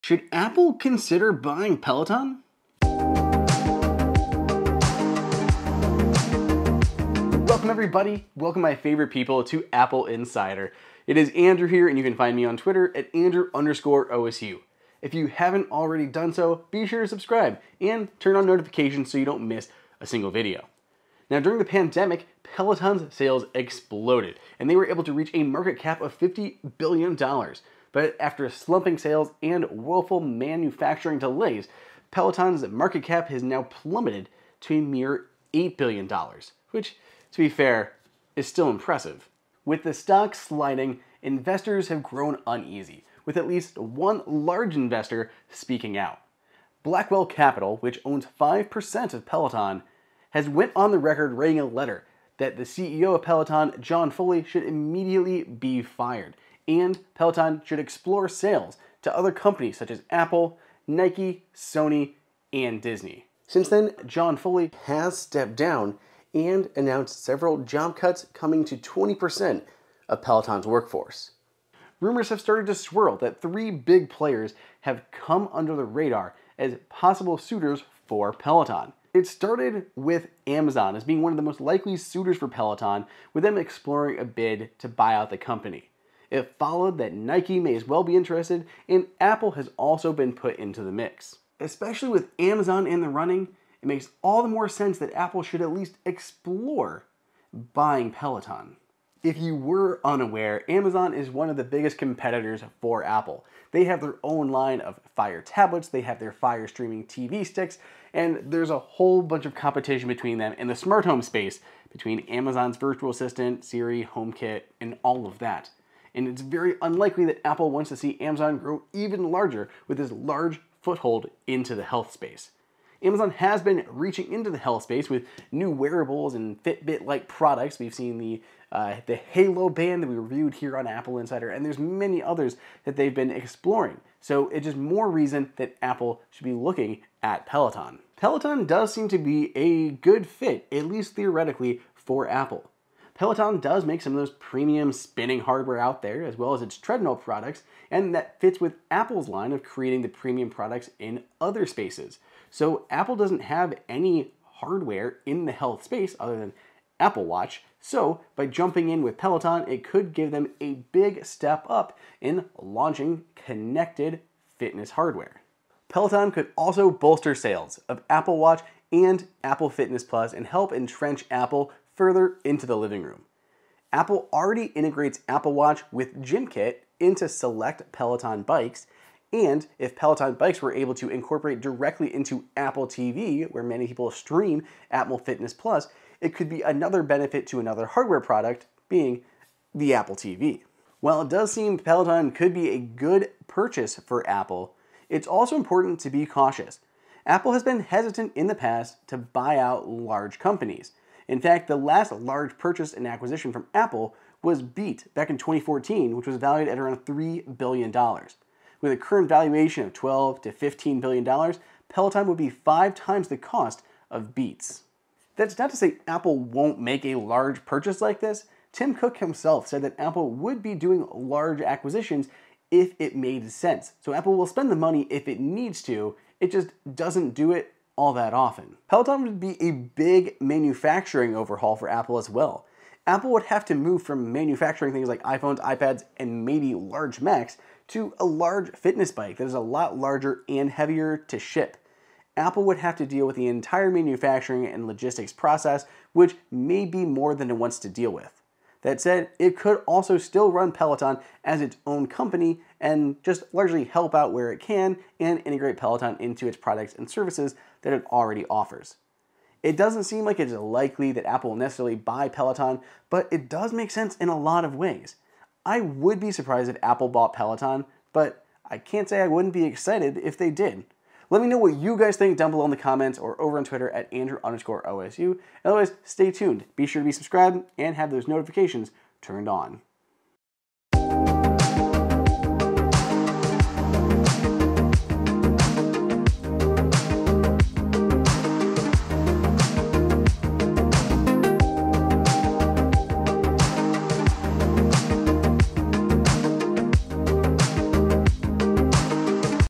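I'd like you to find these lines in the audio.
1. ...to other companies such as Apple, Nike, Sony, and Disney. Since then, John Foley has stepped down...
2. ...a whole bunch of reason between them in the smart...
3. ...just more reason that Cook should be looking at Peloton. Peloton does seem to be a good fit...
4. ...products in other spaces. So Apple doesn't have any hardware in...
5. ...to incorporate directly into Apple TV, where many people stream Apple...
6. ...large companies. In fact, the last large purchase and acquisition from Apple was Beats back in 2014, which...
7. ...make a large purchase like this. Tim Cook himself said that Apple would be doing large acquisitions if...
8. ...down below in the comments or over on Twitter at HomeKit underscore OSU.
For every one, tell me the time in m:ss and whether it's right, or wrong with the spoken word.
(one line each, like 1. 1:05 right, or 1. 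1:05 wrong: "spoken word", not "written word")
1. 0:59 right
2. 1:48 wrong: "competition", not "reason"
3. 2:14 wrong: "Apple", not "Cook"
4. 2:30 right
5. 3:00 right
6. 3:19 right
7. 3:36 right
8. 4:32 wrong: "Andrew", not "HomeKit".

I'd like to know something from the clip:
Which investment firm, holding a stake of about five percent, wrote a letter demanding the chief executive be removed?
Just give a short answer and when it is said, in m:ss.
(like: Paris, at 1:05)
Blackwell Capital, at 0:46.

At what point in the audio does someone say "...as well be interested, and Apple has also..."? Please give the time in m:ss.
1:27.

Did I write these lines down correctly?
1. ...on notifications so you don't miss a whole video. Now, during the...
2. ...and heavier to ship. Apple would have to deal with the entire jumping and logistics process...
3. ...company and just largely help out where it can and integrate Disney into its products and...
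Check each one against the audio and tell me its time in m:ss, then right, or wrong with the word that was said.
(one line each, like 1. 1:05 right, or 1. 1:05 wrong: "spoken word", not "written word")
1. 0:18 wrong: "single", not "whole"
2. 4:00 wrong: "manufacturing", not "jumping"
3. 4:12 wrong: "Peloton", not "Disney".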